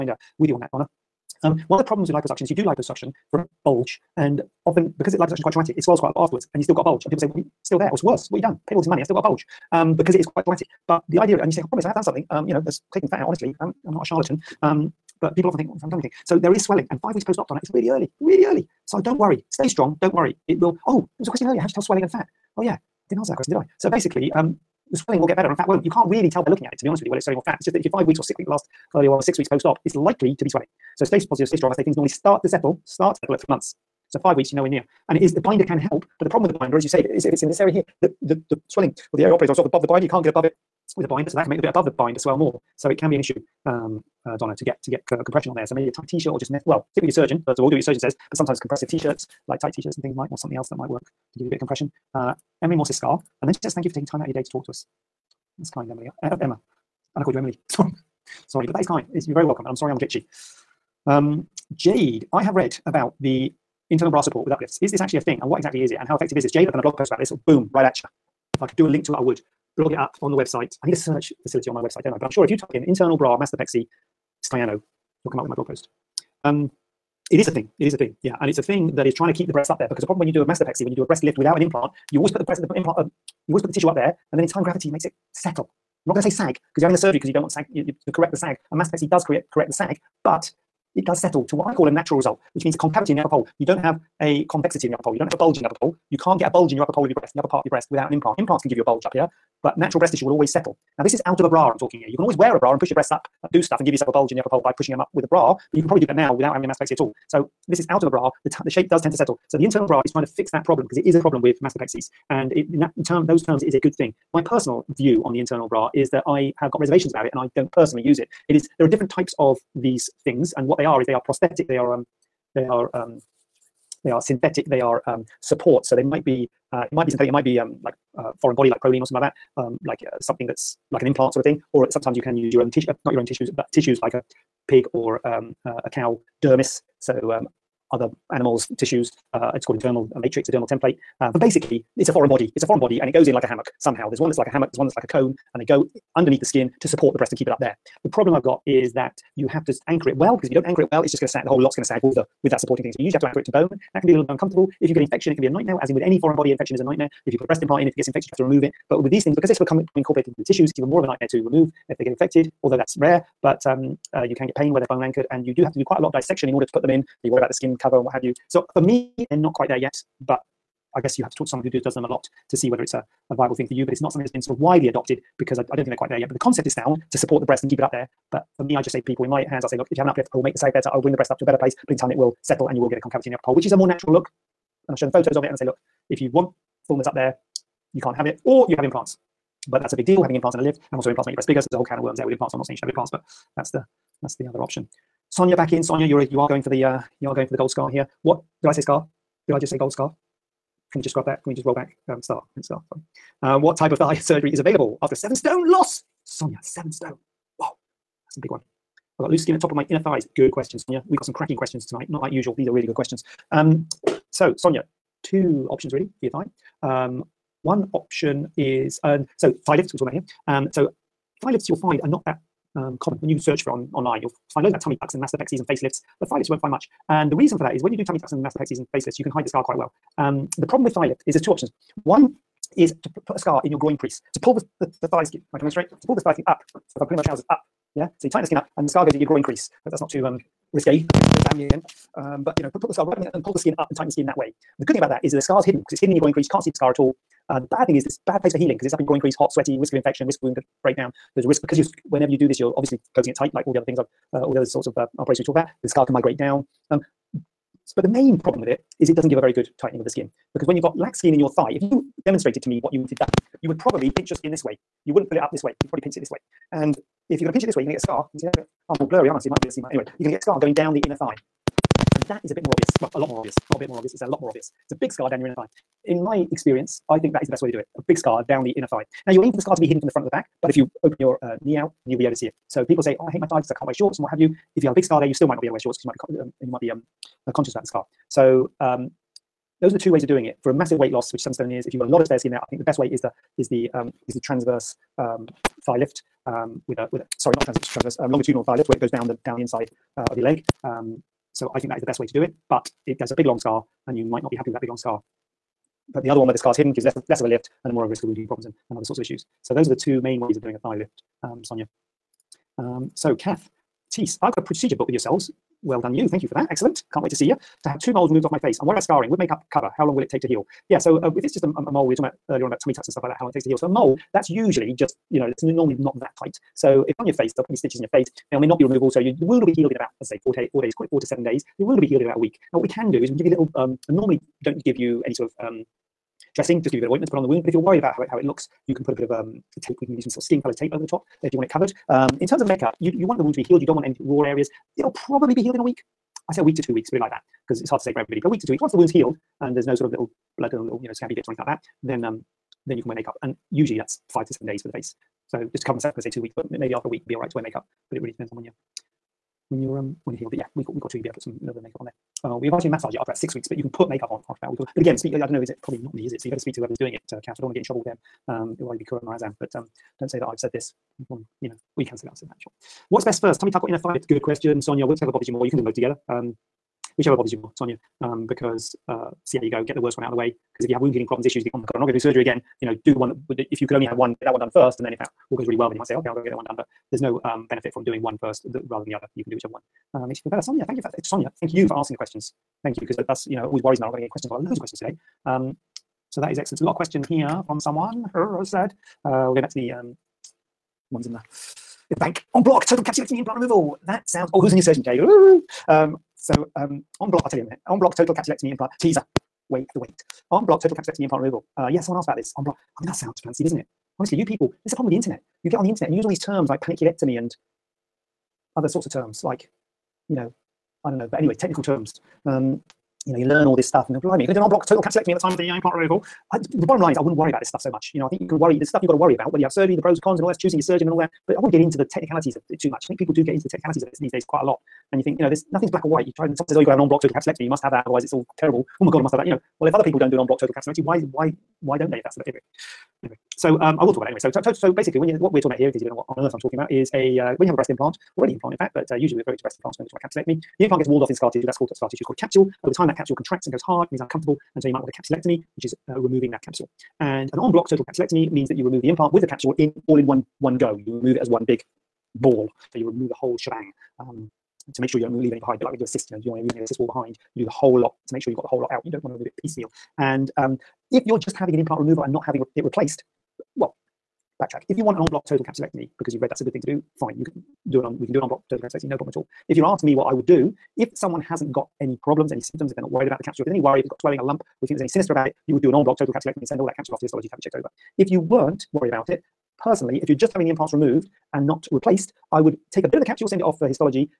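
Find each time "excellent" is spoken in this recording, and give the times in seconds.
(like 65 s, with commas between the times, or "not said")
316 s, 396 s.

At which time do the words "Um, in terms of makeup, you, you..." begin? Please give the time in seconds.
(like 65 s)
342 s.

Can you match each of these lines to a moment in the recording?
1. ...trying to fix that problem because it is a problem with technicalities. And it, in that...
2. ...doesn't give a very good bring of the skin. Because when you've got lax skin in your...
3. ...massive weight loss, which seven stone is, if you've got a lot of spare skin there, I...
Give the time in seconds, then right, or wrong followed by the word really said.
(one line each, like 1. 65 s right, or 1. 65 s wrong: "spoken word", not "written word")
1. 110 s wrong: "mastopexies", not "technicalities"
2. 259 s wrong: "tightening", not "bring"
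3. 290 s right.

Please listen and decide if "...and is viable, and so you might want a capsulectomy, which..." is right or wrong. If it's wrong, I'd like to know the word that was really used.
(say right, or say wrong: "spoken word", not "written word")
wrong: "uncomfortable", not "viable".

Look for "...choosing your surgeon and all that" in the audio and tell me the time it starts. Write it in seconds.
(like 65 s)
430 s.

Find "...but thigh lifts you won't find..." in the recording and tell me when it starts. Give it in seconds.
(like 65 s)
226 s.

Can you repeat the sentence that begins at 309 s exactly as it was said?
So those are the two main ways of doing a thigh lift, um, Sonia.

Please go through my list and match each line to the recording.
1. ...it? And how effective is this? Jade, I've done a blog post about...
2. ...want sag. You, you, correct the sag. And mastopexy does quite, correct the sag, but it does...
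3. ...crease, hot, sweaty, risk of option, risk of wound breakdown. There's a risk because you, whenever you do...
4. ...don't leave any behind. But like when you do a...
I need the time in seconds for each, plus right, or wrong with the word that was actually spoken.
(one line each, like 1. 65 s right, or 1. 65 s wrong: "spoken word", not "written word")
1. 65 s right
2. 87 s wrong: "create", not "quite"
3. 249 s wrong: "infection", not "option"
4. 465 s right.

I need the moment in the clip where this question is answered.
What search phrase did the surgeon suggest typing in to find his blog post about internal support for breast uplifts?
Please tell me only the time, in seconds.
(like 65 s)
72 s.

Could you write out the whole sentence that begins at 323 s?
So a mole, that's usually just, you know, it's normally not that tight.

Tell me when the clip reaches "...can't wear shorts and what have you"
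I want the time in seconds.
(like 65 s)
283 s.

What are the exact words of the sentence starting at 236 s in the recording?
So if I'm pulling my trousers up, yeah?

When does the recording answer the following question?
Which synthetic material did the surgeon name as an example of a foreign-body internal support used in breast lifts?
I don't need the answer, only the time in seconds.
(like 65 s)
128 s.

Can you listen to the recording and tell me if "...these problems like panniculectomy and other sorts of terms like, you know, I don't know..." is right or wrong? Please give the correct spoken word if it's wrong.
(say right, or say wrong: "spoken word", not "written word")
wrong: "terms", not "problems".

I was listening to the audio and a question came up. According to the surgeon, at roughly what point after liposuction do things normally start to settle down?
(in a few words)
3 months.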